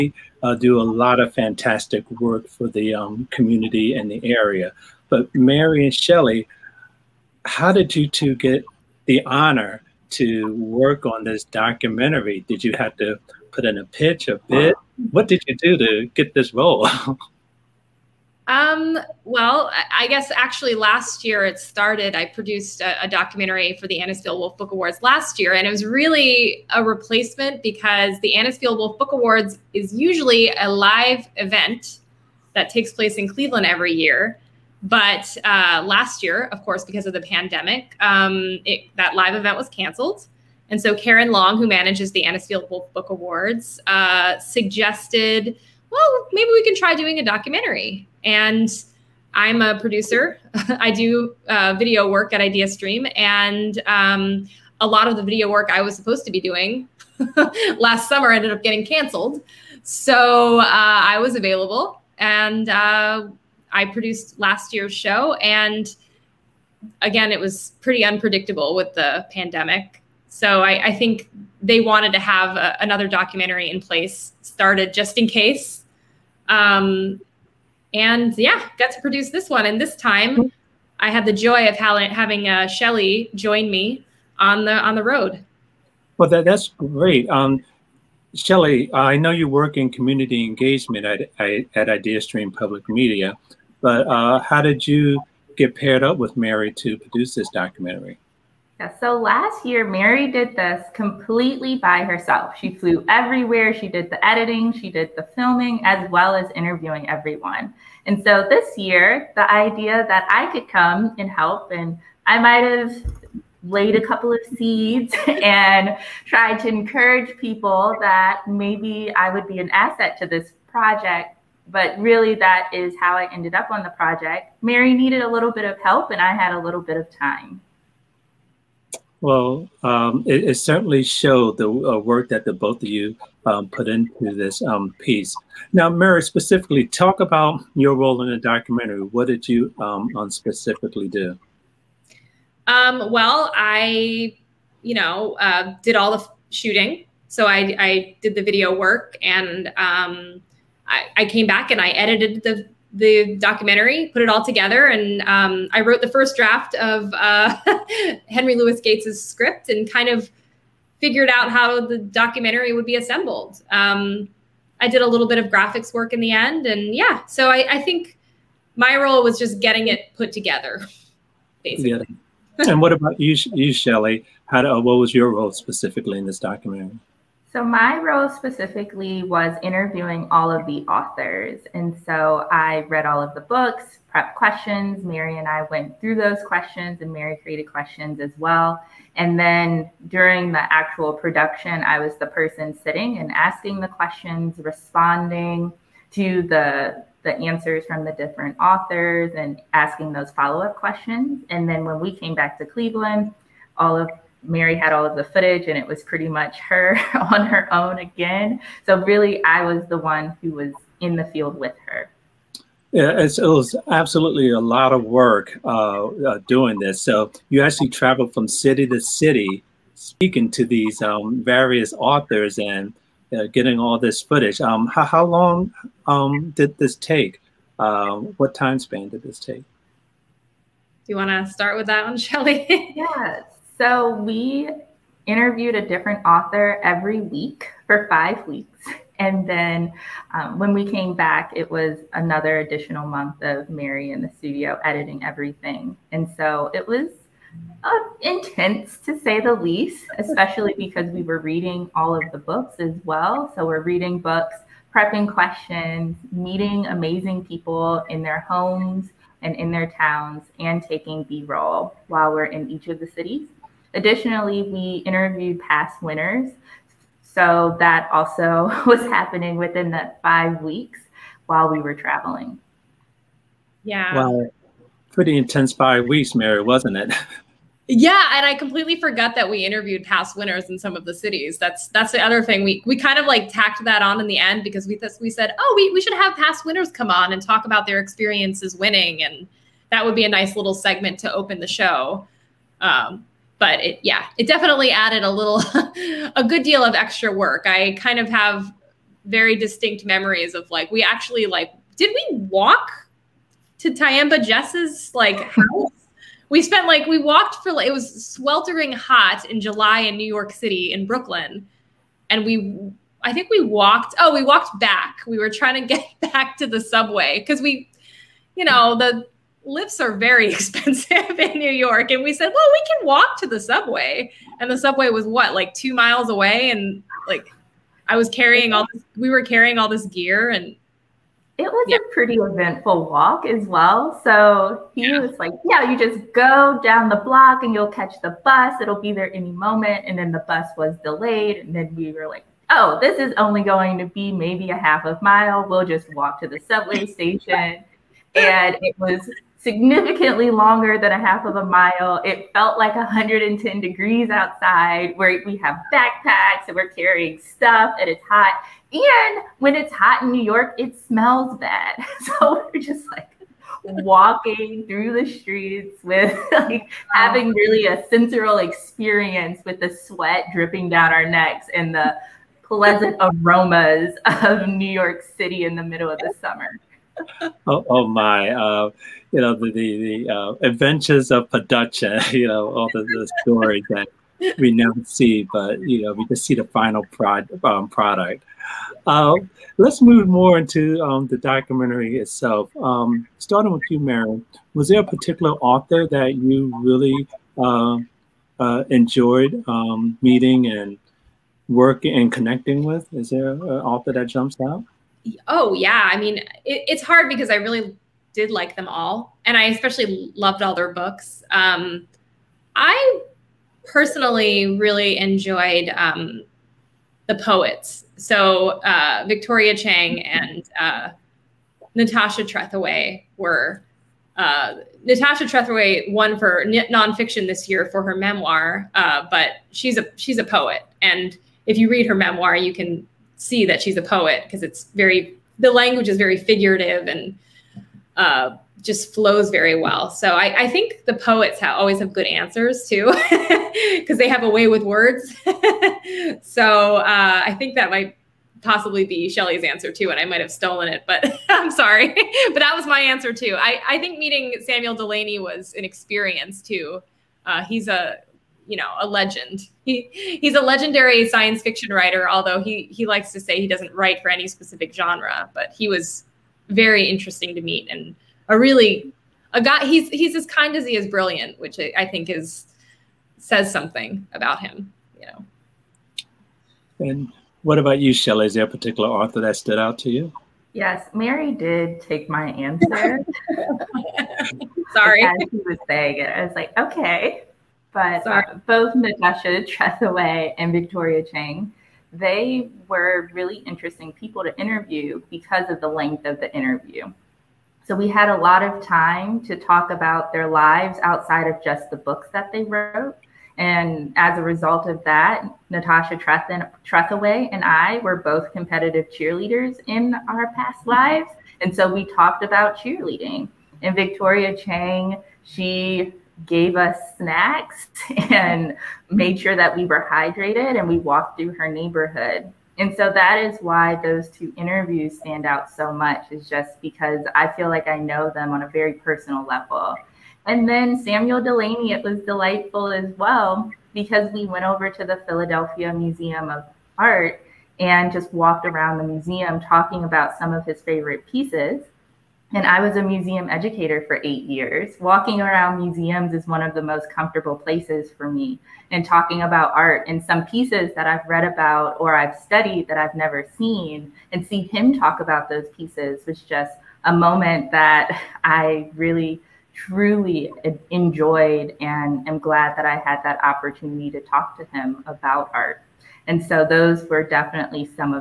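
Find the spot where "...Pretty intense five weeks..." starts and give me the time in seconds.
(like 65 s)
275 s.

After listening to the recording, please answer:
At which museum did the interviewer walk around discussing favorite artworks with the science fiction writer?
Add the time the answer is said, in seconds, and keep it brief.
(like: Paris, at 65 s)
Philadelphia Museum of Art, at 535 s.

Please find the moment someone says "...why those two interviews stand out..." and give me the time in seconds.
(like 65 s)
523 s.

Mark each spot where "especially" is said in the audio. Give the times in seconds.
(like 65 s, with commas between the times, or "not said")
250 s, 409 s.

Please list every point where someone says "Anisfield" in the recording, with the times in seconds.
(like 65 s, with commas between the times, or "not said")
23 s, 28 s, 42 s.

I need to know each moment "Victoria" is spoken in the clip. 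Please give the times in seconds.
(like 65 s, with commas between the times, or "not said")
419 s, 490 s, 513 s.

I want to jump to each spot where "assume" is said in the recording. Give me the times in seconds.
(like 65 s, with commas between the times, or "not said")
not said.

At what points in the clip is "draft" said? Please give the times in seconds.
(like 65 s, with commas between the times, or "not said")
156 s.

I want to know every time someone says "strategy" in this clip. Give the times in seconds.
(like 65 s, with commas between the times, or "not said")
not said.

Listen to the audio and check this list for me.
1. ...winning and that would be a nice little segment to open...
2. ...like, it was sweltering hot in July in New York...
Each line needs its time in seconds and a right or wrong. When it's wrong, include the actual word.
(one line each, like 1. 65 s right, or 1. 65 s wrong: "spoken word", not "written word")
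1. 288 s right
2. 307 s right.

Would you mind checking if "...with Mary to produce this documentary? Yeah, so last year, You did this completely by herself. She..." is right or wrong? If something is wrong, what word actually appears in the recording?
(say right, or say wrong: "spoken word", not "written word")
wrong: "Mary", not "You".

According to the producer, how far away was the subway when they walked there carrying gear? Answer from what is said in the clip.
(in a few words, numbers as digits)
2 miles.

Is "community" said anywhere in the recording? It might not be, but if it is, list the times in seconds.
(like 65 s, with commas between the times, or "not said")
3 s, 89 s.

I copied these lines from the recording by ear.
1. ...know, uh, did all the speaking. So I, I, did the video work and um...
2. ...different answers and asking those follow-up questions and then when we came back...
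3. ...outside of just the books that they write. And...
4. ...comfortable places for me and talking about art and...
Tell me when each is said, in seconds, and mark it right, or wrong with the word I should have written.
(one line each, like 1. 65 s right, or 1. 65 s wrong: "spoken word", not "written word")
1. 144 s wrong: "shooting", not "speaking"
2. 198 s wrong: "authors", not "answers"
3. 501 s wrong: "wrote", not "write"
4. 547 s right.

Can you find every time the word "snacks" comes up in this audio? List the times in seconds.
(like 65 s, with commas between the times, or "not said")
517 s.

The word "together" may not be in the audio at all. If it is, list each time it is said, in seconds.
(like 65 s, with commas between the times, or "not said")
154 s, 170 s.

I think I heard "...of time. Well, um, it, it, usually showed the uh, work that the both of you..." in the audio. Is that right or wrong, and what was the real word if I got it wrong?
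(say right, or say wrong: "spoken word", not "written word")
wrong: "certainly", not "usually".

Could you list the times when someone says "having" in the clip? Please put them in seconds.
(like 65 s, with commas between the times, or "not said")
81 s, 367 s.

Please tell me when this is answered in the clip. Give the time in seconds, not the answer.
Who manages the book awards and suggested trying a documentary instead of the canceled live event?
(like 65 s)
40 s.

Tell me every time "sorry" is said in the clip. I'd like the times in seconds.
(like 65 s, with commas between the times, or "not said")
451 s, 484 s.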